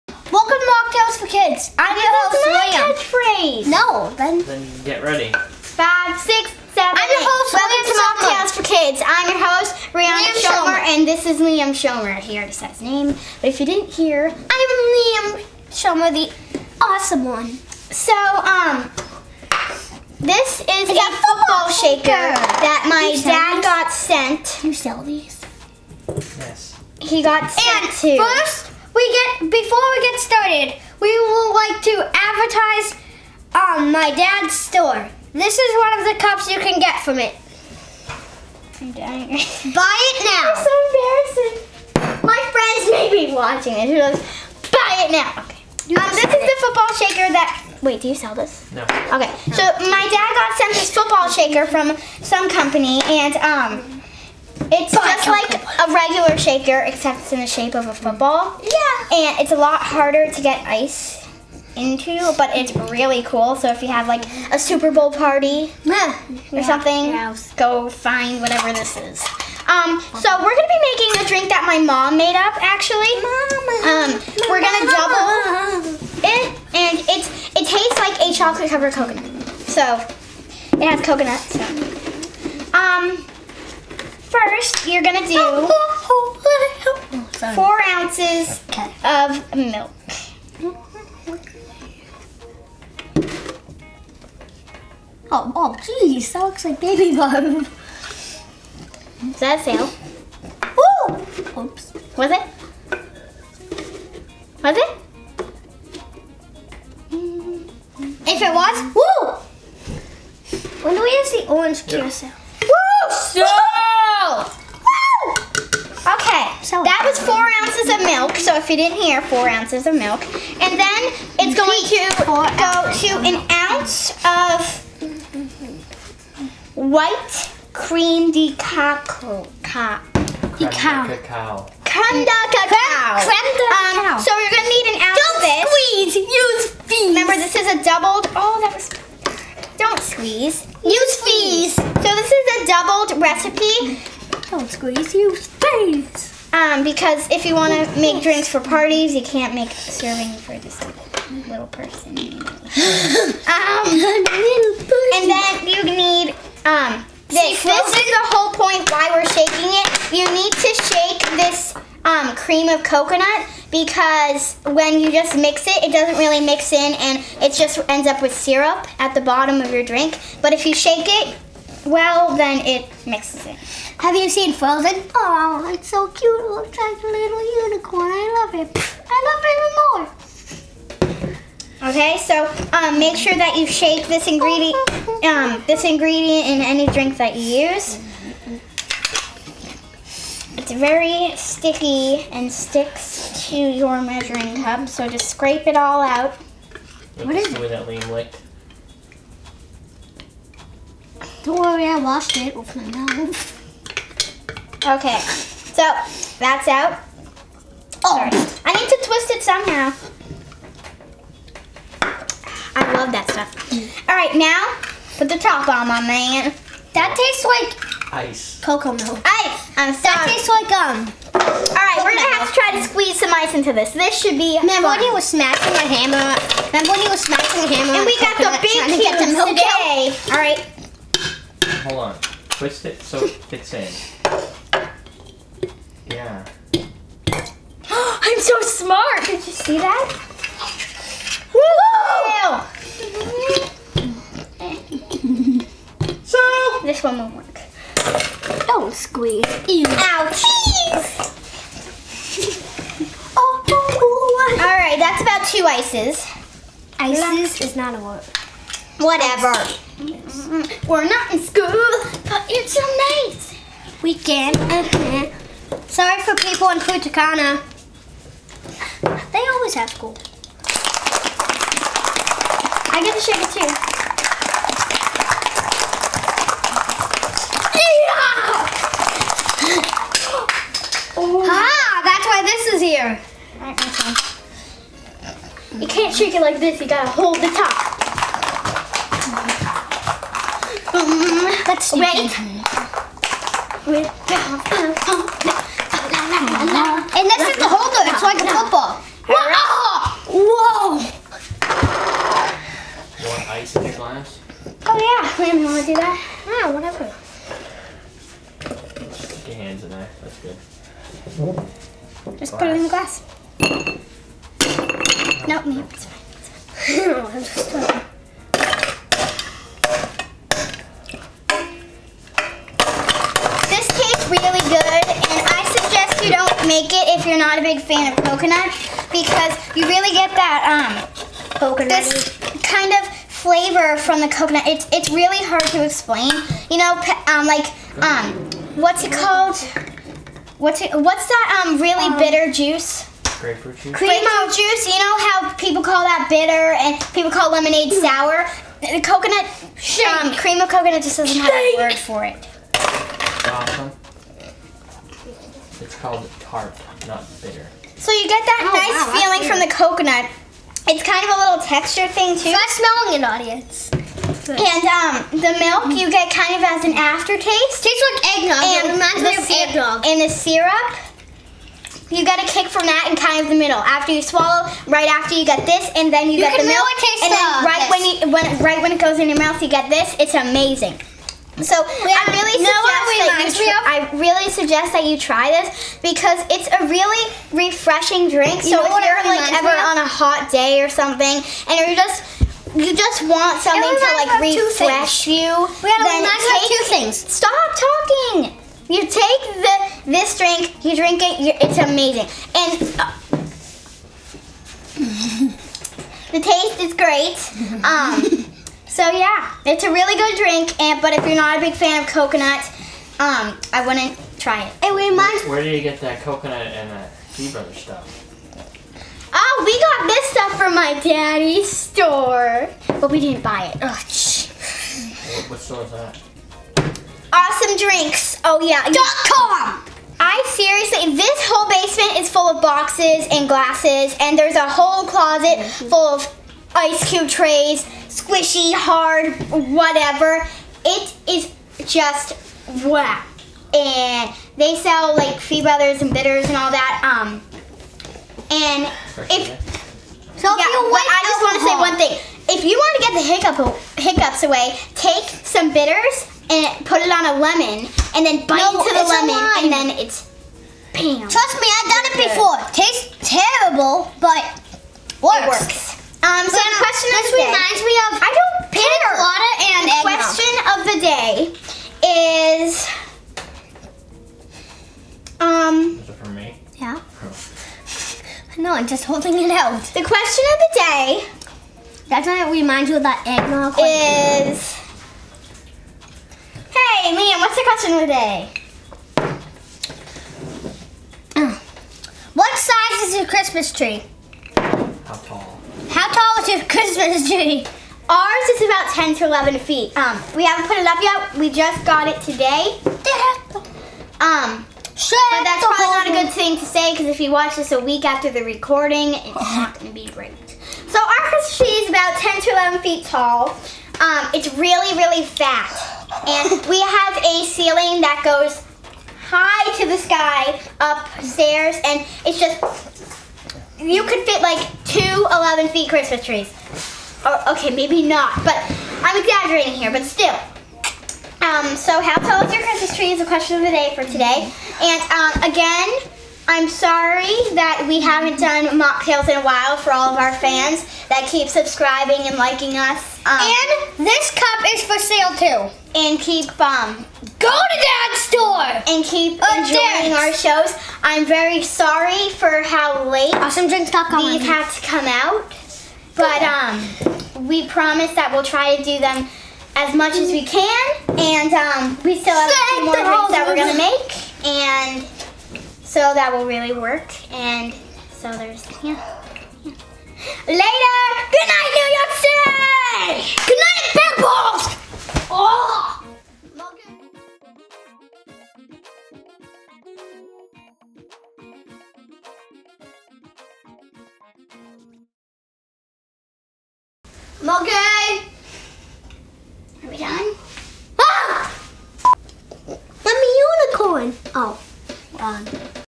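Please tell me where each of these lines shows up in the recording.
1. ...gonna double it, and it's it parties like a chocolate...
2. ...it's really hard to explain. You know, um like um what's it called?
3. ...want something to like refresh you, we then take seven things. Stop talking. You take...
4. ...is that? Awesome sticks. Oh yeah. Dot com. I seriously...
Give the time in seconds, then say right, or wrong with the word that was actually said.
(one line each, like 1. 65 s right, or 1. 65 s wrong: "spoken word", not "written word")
1. 74 s wrong: "tastes", not "parties"
2. 334 s right
3. 393 s wrong: "two", not "seven"
4. 425 s wrong: "drinks", not "sticks".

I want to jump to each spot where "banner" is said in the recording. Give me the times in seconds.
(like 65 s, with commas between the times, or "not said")
not said.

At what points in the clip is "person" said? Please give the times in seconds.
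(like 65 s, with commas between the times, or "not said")
151 s.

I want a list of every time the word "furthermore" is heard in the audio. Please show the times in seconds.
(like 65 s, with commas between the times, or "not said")
not said.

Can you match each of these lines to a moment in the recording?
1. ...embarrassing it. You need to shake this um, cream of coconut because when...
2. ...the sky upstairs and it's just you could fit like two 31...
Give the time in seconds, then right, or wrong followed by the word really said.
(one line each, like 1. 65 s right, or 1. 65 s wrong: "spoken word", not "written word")
1. 159 s wrong: "shaking", not "embarrassing"
2. 519 s wrong: "11", not "31".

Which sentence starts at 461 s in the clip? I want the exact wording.
Trust me, I've done it before.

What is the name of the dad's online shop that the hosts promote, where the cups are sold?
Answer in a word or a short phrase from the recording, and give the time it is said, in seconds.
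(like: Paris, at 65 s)
awesomedrinks.com, at 553 s.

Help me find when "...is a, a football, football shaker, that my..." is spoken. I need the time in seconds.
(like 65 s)
20 s.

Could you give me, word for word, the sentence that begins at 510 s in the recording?
So our Christmas tree is about 10 to 11 feet tall.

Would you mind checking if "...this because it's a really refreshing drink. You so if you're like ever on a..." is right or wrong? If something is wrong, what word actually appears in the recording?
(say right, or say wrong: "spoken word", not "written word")
right.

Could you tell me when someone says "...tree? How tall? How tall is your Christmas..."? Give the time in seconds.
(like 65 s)
493 s.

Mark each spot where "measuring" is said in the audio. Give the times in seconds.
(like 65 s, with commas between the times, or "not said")
193 s.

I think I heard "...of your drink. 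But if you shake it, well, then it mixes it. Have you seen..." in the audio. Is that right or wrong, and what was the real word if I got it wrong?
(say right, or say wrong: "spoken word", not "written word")
right.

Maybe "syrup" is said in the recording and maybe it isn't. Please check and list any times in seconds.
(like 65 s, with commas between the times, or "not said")
168 s, 370 s.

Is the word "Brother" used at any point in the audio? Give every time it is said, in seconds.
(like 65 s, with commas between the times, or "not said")
417 s, 445 s.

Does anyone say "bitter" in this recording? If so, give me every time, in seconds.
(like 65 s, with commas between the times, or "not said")
342 s, 346 s, 357 s, 446 s, 455 s.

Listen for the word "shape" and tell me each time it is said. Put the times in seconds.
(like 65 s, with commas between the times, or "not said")
57 s.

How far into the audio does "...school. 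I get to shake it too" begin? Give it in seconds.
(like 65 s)
269 s.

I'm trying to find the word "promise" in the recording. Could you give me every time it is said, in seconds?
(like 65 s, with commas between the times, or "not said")
557 s.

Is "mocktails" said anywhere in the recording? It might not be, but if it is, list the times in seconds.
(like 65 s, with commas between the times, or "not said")
8 s, 538 s.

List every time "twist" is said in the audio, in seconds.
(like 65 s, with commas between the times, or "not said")
209 s, 232 s.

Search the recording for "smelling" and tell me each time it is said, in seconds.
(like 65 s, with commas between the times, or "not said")
362 s.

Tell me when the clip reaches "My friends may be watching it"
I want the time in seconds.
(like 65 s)
42 s.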